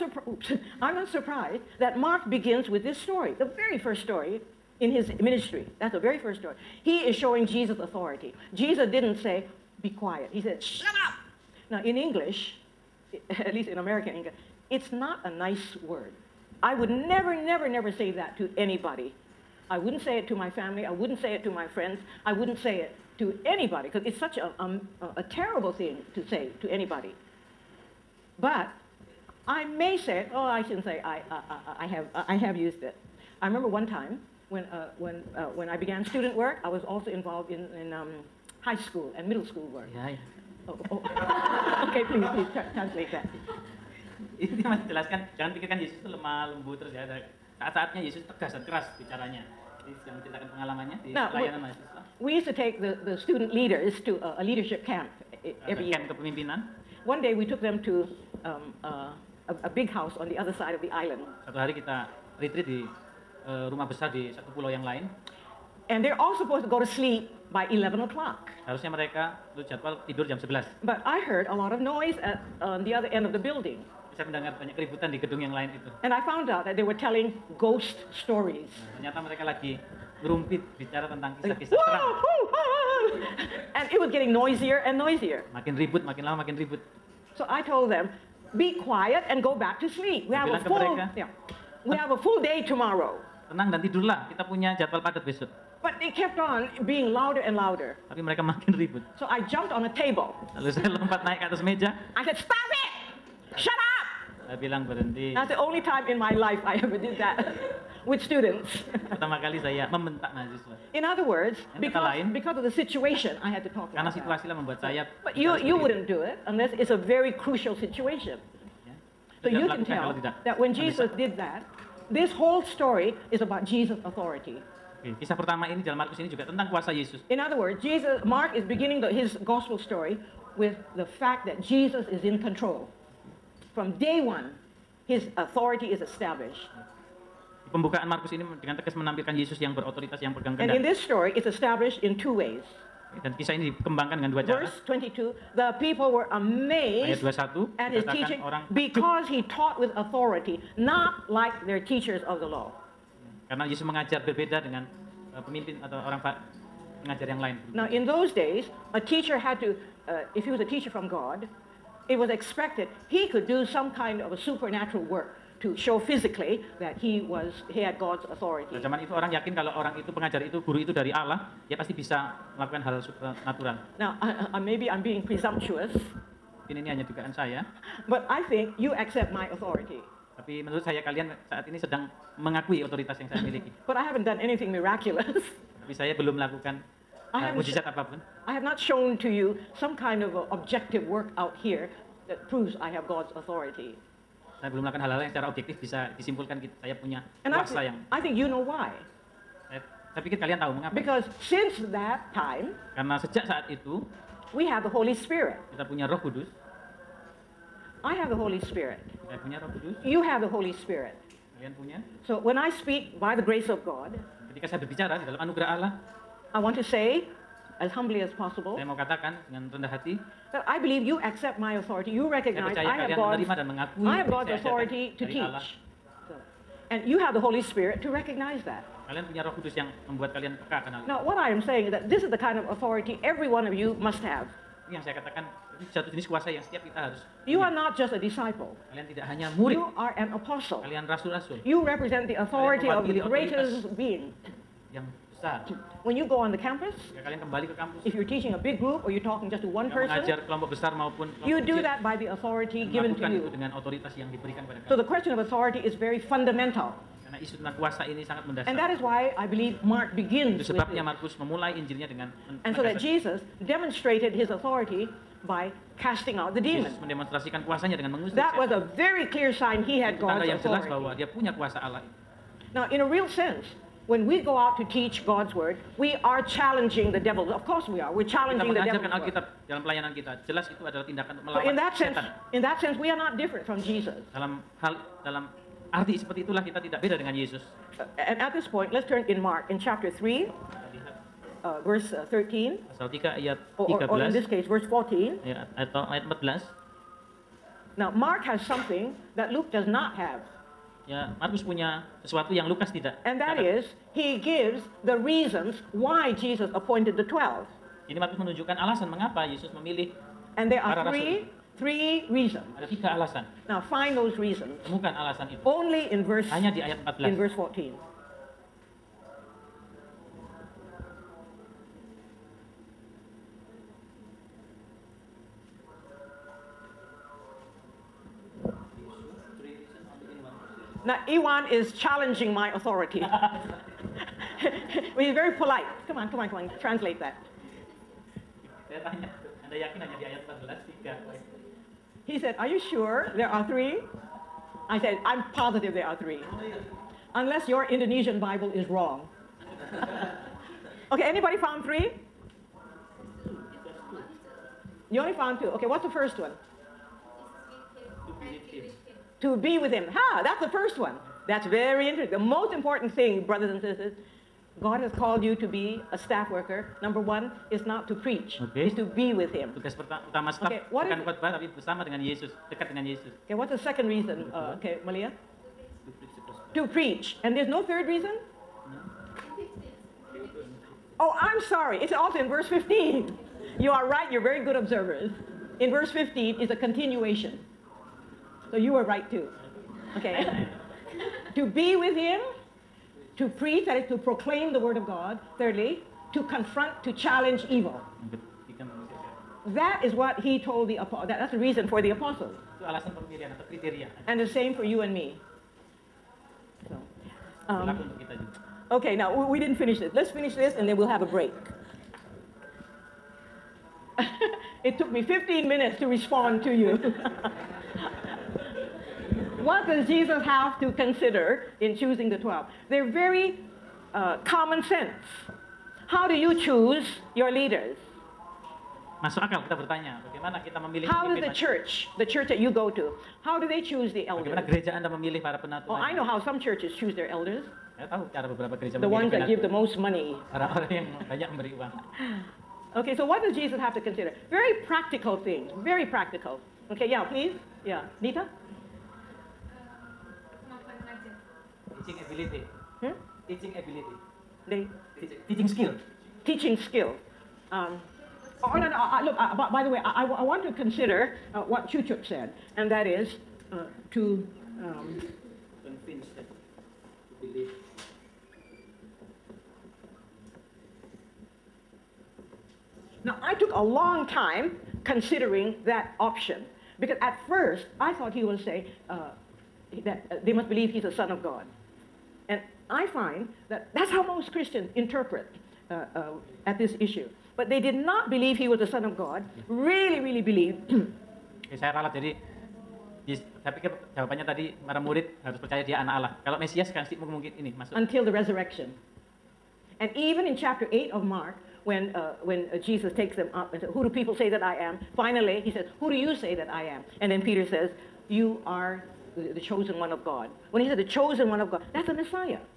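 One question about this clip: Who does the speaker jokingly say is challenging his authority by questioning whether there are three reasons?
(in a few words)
Iwan.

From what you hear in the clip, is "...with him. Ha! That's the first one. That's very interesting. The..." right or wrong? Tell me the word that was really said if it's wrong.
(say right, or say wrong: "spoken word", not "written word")
right.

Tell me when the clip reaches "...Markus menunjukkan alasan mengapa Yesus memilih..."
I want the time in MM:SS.
05:08.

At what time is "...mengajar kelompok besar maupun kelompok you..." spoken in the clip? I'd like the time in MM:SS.
04:10.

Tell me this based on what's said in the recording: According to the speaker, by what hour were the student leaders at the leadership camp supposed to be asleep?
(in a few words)
11 o'clock.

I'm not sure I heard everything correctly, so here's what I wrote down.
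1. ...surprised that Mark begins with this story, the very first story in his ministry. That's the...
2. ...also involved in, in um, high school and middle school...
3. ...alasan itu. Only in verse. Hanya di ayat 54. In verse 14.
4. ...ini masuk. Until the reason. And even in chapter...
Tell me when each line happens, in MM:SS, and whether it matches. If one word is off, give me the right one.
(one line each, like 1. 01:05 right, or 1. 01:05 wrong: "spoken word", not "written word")
1. 00:01 right
2. 00:36 right
3. 05:15 wrong: "14", not "54"
4. 08:17 wrong: "resurrection", not "reason".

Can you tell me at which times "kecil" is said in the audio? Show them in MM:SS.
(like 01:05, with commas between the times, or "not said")
04:11.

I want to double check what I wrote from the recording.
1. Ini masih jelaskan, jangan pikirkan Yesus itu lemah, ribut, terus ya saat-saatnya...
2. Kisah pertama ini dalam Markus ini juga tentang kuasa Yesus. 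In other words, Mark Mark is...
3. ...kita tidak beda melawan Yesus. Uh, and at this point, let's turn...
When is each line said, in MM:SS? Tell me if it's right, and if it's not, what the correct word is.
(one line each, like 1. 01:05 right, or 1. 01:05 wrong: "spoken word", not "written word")
1. 00:44 wrong: "lembut", not "ribut"
2. 02:05 wrong: "Jesus", not "Mark"
3. 04:46 wrong: "dengan", not "melawan".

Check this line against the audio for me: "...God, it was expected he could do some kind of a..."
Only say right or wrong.
right.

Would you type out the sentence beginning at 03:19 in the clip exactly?
Saya, saya pikir kalian tahu mengapa.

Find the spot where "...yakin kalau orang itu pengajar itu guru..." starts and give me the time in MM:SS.
02:49.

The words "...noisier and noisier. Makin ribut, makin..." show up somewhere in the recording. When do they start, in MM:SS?
01:24.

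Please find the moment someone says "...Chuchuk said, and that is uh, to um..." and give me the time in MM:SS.
07:41.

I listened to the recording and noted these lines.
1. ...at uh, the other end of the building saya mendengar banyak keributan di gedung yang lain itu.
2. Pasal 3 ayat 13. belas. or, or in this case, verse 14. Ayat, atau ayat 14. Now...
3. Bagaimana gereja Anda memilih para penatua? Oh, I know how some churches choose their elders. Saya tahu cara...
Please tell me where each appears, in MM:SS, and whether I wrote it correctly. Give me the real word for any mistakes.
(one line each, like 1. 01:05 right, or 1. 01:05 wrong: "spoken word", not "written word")
1. 01:12 right
2. 04:52 right
3. 07:14 right.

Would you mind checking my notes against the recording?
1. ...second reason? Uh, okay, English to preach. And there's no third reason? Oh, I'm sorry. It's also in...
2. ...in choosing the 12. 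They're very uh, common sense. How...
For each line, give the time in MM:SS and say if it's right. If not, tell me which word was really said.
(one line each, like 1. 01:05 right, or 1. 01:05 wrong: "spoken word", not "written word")
1. 06:13 wrong: "Malia", not "English"
2. 07:01 right.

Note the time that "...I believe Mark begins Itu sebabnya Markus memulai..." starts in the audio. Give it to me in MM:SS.
04:19.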